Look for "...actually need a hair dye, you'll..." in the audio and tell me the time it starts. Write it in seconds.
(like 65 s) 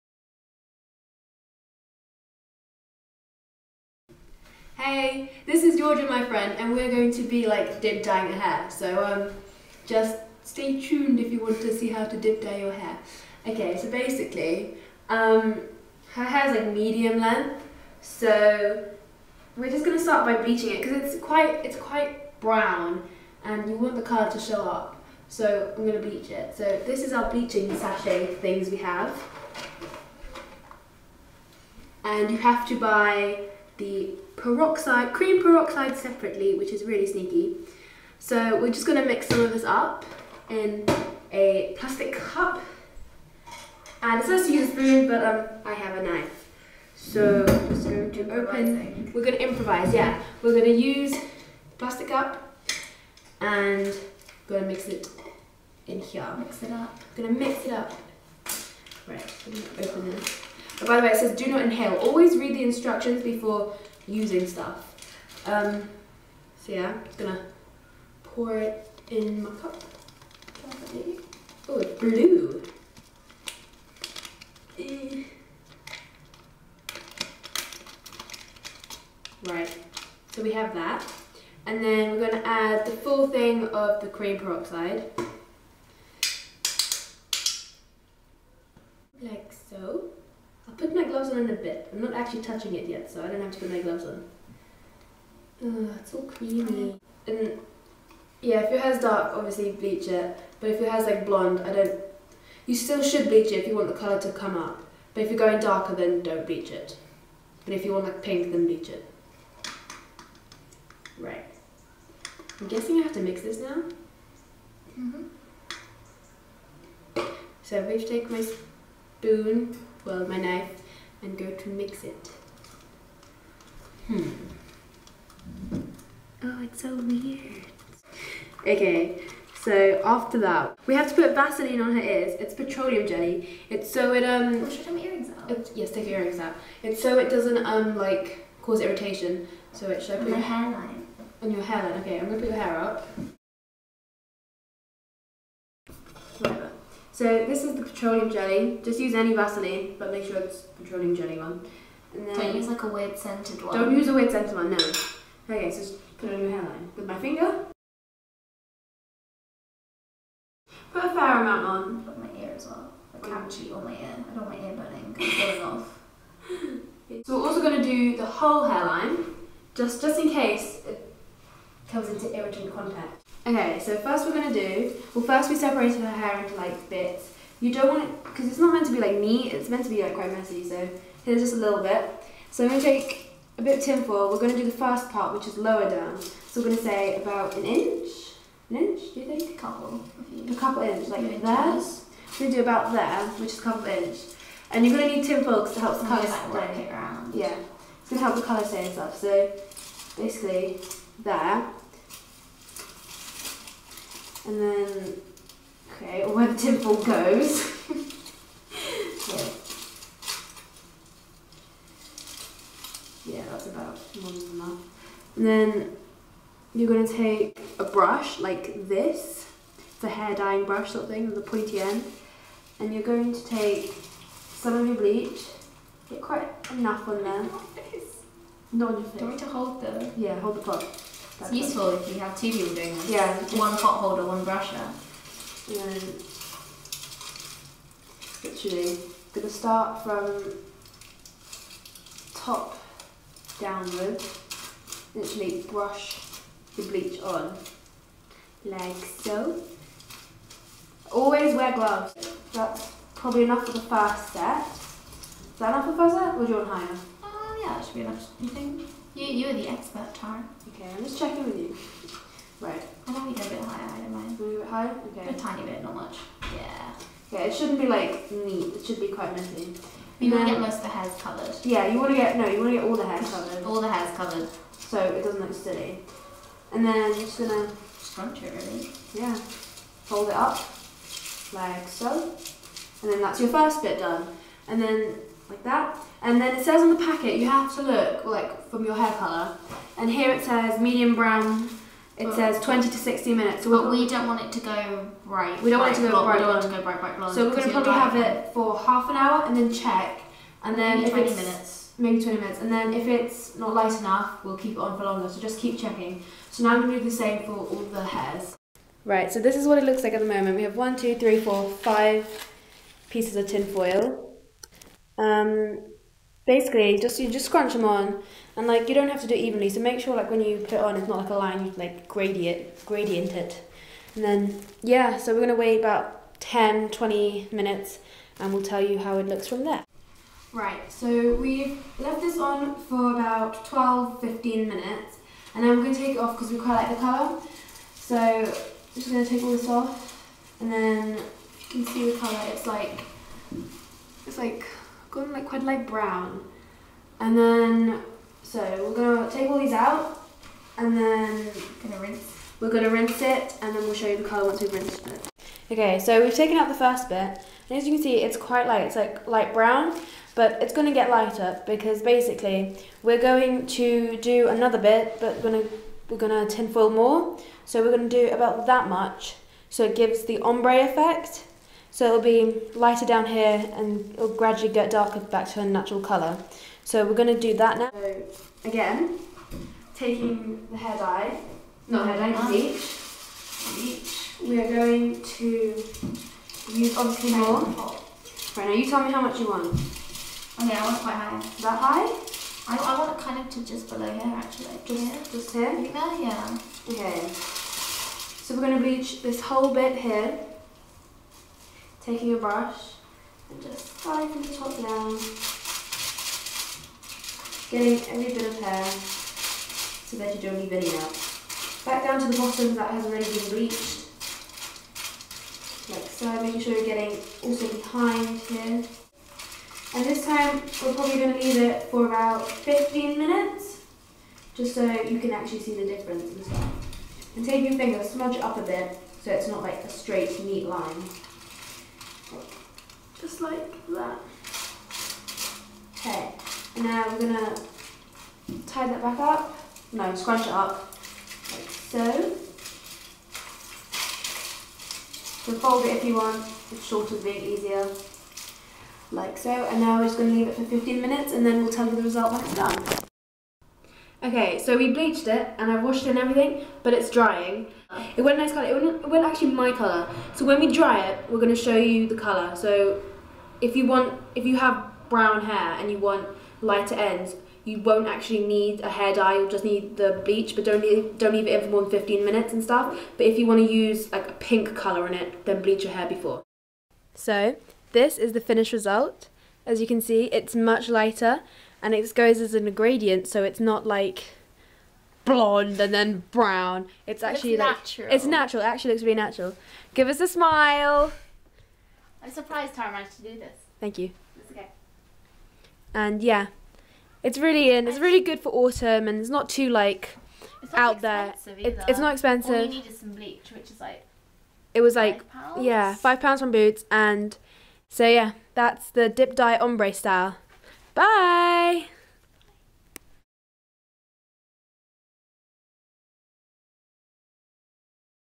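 468 s.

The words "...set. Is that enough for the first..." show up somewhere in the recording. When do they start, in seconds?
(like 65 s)
254 s.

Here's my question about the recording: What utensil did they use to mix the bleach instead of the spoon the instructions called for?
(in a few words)
a knife.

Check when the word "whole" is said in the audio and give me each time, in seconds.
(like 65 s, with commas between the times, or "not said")
168 s, 399 s.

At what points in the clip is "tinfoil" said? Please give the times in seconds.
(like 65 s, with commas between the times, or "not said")
183 s, 195 s, 206 s, 366 s.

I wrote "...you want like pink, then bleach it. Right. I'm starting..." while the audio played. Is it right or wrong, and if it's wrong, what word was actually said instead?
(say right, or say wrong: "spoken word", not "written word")
wrong: "guessing", not "starting".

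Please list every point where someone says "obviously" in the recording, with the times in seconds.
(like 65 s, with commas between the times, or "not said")
99 s, 386 s.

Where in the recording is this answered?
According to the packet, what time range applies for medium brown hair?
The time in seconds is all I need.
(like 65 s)
292 s.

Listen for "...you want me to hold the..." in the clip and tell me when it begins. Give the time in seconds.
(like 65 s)
229 s.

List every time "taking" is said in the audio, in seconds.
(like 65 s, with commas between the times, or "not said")
379 s, 402 s.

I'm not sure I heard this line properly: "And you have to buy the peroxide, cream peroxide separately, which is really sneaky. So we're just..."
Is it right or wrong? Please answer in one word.
right.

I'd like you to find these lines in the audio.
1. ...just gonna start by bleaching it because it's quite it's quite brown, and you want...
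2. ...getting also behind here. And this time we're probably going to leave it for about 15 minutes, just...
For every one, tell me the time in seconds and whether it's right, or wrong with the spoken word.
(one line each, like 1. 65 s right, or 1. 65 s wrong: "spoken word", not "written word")
1. 19 s right
2. 416 s right.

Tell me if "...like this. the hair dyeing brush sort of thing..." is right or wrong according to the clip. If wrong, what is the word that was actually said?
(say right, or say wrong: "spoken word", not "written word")
right.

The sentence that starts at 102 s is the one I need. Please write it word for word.
You still should bleach it if you want the colour to come up.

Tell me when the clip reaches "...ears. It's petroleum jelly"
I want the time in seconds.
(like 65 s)
132 s.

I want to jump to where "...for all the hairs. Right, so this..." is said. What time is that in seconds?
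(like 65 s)
307 s.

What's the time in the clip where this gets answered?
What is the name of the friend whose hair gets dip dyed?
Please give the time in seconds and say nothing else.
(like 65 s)
5 s.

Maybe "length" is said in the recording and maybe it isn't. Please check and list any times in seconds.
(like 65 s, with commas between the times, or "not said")
17 s.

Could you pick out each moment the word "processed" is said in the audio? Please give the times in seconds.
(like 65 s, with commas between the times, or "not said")
not said.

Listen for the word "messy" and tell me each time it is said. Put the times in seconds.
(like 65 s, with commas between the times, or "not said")
180 s, 269 s.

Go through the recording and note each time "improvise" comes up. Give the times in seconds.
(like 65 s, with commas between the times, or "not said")
49 s.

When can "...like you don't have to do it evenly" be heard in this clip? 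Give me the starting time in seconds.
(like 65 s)
318 s.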